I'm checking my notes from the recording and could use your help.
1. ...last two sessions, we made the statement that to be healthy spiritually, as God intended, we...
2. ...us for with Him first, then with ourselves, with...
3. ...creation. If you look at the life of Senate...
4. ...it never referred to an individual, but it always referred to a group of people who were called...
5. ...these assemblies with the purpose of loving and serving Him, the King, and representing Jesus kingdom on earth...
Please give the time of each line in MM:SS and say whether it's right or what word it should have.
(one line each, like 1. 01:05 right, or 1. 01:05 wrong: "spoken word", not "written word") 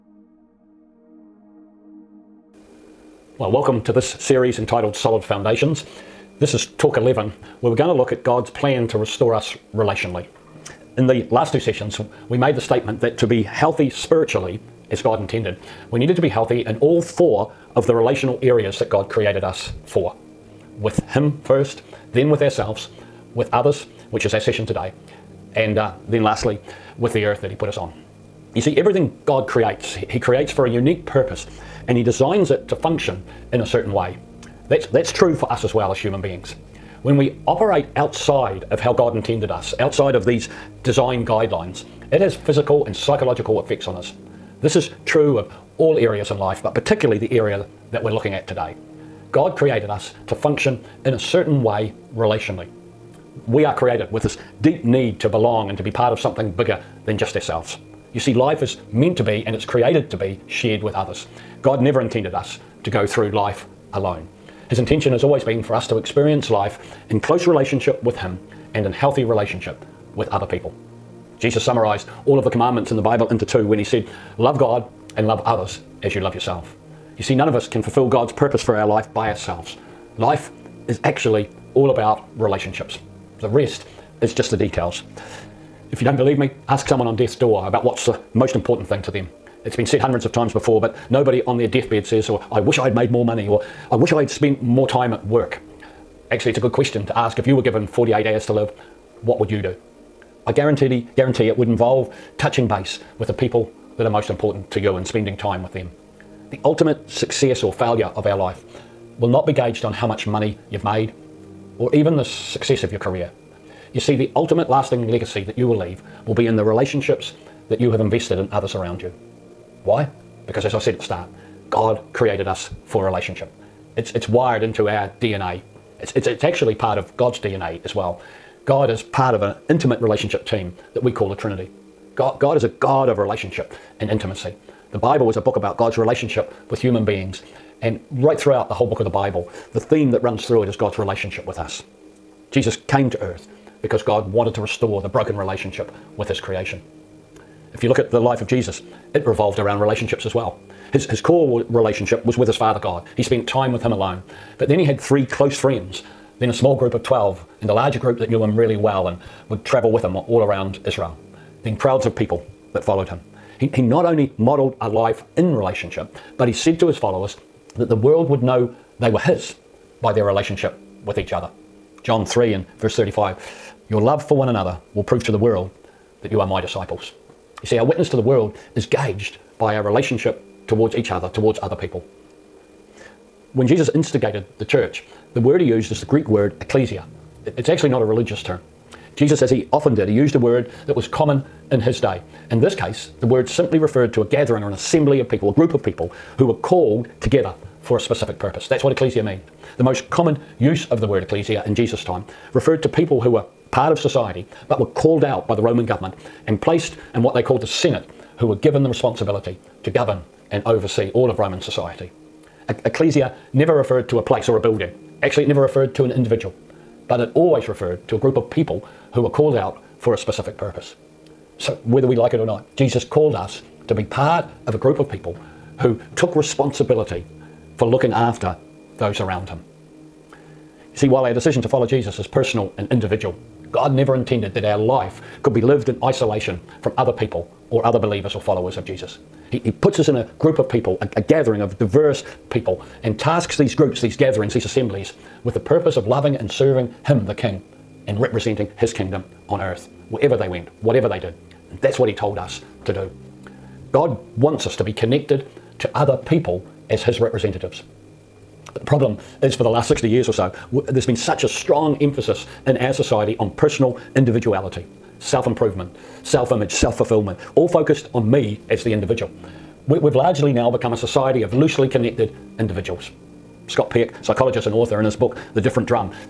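1. 00:11 right
2. 00:19 right
3. 02:26 wrong: "Jesus", not "Senate"
4. 03:35 right
5. 04:04 wrong: "His", not "Jesus".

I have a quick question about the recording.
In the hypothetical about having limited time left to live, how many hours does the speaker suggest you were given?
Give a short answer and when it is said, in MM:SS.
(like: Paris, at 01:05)
48, at 01:37.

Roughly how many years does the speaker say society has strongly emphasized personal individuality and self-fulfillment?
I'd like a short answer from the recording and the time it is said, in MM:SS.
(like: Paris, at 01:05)
60, at 04:19.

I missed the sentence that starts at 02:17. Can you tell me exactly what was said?
And right throughout the whole book of the Bible, the theme that runs through it is God's relationship with us.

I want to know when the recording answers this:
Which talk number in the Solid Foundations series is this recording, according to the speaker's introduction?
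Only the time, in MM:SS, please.
00:06.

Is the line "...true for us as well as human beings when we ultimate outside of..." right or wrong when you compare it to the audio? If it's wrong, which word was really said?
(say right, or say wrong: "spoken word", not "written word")
wrong: "operate", not "ultimate".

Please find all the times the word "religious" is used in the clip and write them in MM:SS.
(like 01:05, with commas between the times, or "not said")
03:08.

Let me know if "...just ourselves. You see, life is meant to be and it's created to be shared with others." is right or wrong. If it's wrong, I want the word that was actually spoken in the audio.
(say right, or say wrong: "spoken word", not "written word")
right.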